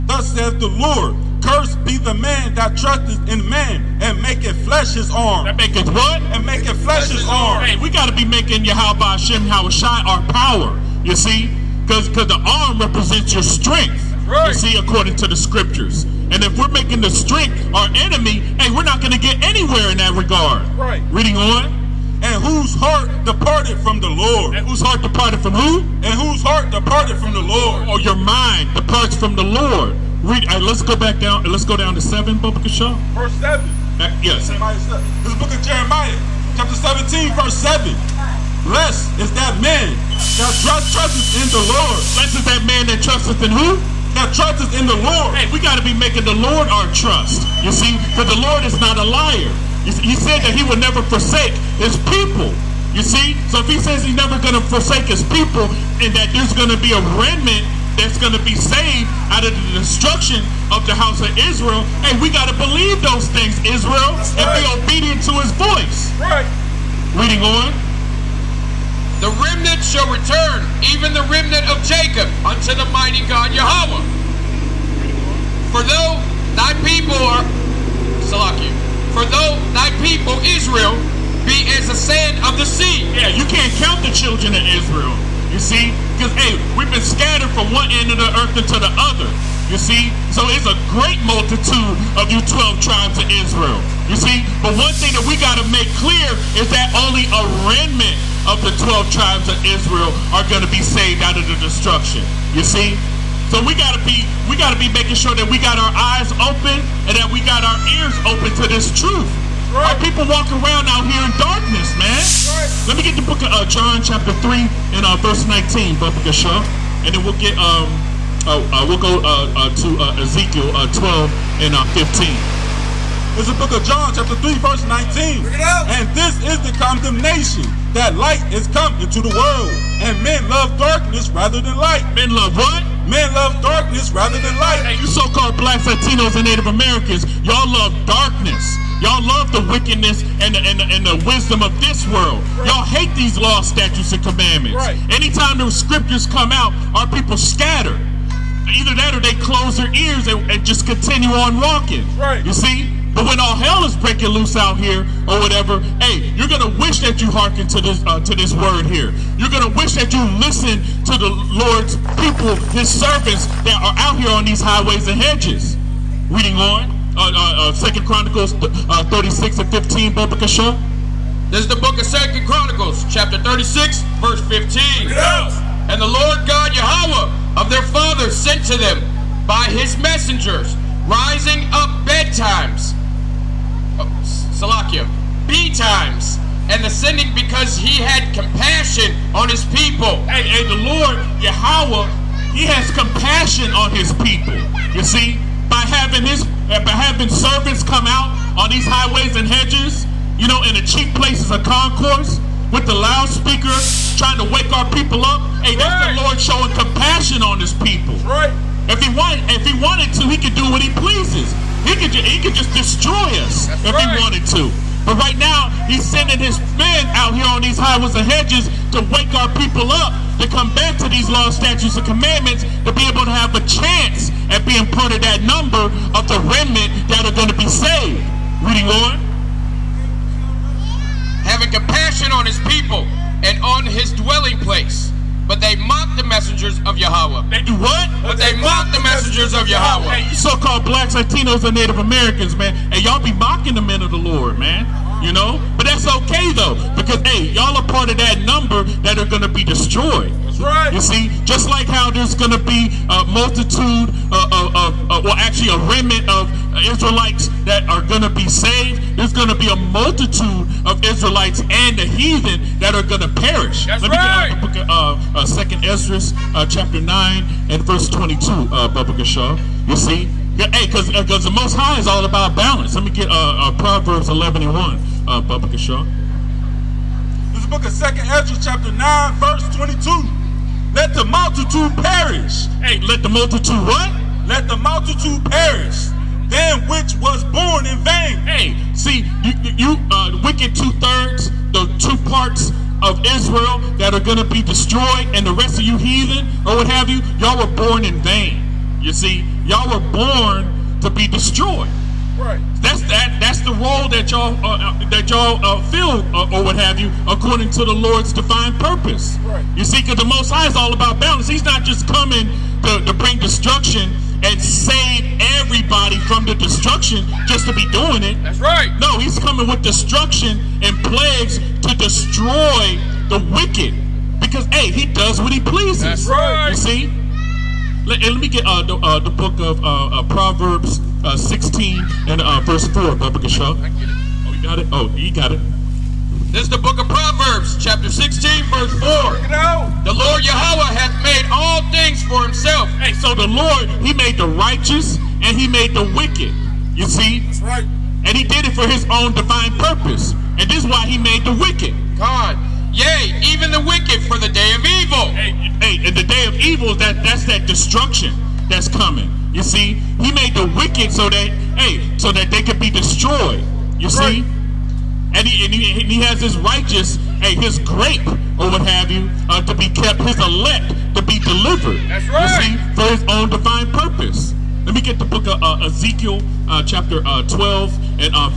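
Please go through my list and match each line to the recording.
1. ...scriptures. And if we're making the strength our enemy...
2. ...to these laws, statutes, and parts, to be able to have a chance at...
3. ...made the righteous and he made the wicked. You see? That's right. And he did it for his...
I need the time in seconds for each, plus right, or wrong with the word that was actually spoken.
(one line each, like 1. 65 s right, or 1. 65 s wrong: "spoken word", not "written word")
1. 15 s right
2. 220 s wrong: "commandments", not "parts"
3. 344 s right.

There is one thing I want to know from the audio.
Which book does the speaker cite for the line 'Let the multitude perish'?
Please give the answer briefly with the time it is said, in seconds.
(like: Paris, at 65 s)
Second Esdras, at 265 s.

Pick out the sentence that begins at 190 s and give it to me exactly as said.
Hey, hey, the Lord, Yahweh, he has compassion on his people.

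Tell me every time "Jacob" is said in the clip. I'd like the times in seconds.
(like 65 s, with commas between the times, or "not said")
71 s.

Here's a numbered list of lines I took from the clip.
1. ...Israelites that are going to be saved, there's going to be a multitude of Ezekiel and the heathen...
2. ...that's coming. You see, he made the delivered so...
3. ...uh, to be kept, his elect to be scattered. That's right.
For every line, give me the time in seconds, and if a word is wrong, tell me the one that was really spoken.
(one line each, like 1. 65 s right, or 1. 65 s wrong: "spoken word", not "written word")
1. 256 s wrong: "Israelites", not "Ezekiel"
2. 358 s wrong: "wicked", not "delivered"
3. 369 s wrong: "delivered", not "scattered".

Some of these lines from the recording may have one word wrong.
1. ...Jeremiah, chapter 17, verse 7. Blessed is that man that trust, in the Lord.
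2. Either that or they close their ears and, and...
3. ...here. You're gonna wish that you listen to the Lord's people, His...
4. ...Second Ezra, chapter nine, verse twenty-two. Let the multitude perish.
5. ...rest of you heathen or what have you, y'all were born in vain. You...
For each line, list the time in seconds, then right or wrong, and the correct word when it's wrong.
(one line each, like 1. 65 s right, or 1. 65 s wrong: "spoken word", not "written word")
1. 35 s right
2. 148 s right
3. 158 s right
4. 277 s right
5. 295 s right.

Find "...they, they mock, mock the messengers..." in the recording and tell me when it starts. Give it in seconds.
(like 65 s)
238 s.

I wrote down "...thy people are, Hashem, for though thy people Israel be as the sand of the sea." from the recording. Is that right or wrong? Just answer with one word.
wrong.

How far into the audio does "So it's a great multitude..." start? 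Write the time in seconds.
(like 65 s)
90 s.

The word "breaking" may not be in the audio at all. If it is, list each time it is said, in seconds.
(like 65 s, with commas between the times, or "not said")
153 s.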